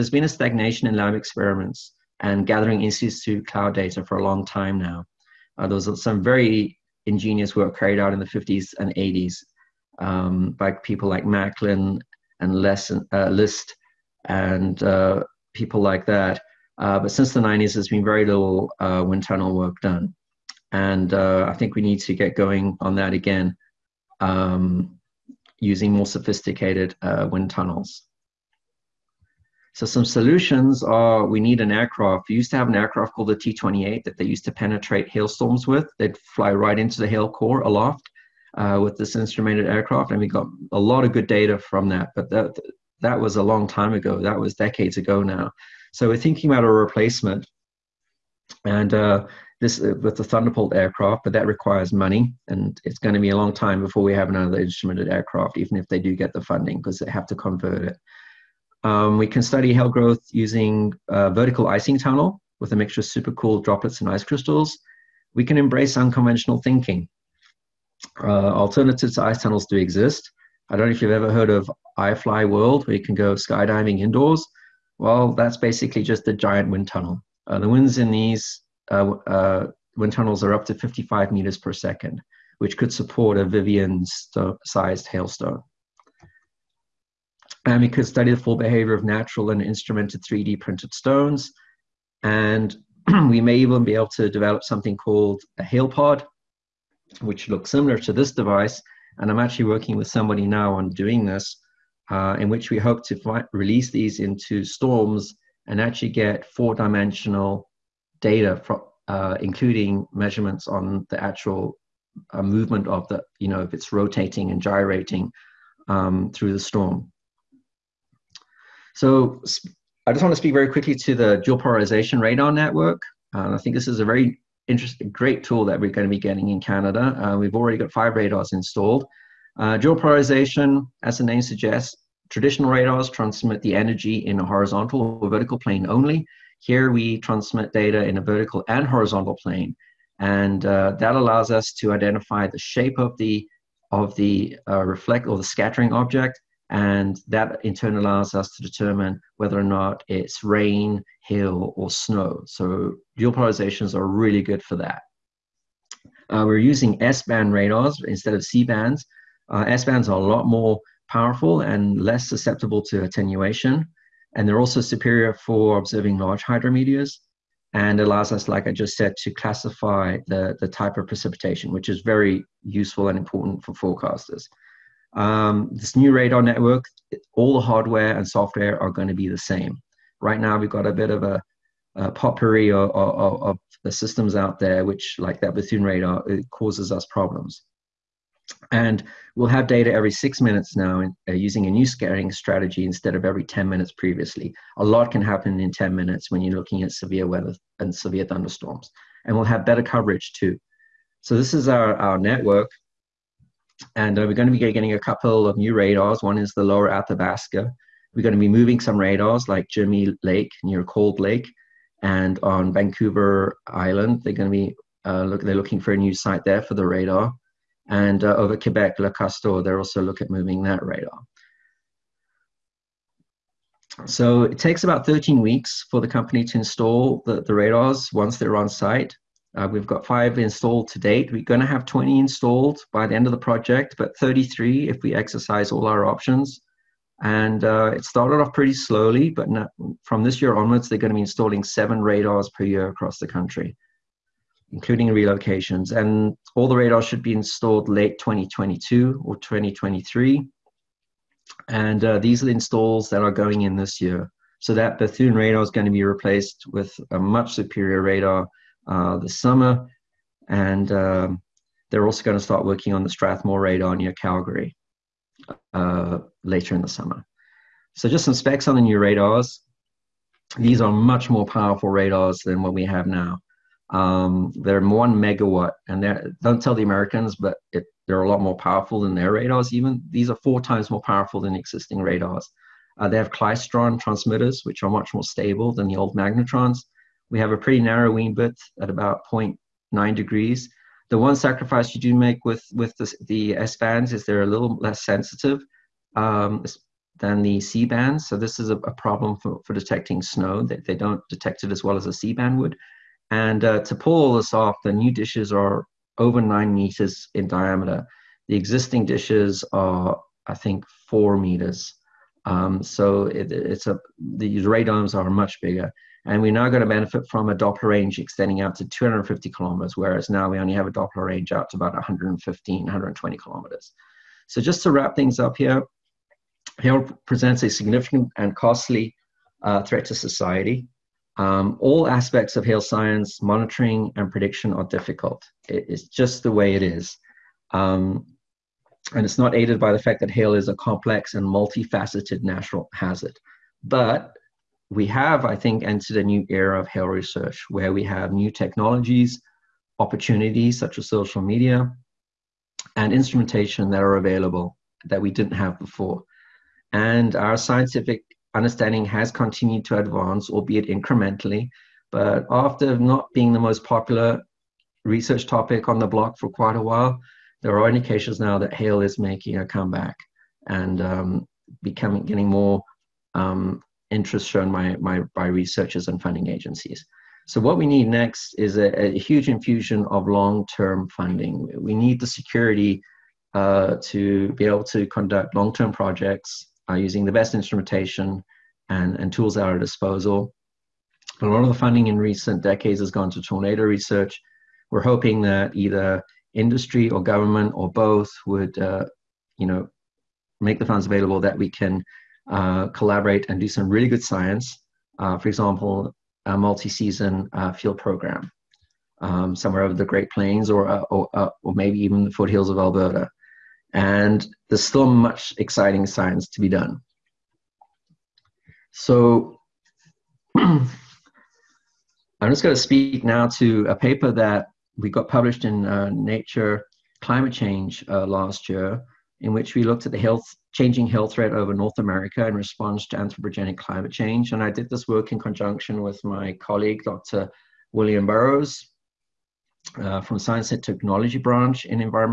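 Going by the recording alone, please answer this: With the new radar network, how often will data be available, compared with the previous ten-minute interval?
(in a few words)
every 6 minutes.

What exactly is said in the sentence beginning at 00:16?
Uh, but since the 90s, there's been very little uh, wind tunnel work done.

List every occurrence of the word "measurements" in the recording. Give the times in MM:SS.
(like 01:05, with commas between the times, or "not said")
01:50.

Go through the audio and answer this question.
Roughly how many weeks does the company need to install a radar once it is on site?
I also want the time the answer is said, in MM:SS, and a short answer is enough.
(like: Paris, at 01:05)
13 weeks, at 03:45.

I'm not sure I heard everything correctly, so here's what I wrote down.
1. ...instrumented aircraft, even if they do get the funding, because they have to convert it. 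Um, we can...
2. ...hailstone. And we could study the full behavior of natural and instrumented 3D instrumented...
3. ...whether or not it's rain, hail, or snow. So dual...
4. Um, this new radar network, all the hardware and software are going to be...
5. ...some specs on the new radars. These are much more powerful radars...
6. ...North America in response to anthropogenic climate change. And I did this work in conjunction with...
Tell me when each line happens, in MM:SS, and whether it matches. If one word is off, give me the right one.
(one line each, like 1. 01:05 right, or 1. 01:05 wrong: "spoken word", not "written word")
1. 00:54 right
2. 01:25 wrong: "printed", not "instrumented"
3. 02:29 right
4. 02:55 right
5. 04:28 right
6. 07:11 right.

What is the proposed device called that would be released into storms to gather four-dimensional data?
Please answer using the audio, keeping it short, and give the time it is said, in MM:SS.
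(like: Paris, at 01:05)
hail pod, at 01:35.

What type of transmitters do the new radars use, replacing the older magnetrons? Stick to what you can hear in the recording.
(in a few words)
klystron.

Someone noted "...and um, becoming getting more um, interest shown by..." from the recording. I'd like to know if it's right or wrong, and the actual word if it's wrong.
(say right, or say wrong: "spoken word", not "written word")
right.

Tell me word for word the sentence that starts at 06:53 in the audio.
And there's still much exciting science to be done.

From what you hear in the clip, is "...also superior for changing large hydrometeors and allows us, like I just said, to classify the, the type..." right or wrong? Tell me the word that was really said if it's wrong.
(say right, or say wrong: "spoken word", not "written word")
wrong: "observing", not "changing".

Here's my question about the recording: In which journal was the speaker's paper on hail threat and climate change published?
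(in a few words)
Nature Climate Change.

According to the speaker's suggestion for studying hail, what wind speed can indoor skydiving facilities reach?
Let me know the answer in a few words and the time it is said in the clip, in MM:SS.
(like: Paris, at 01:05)
55 meters per second, at 01:20.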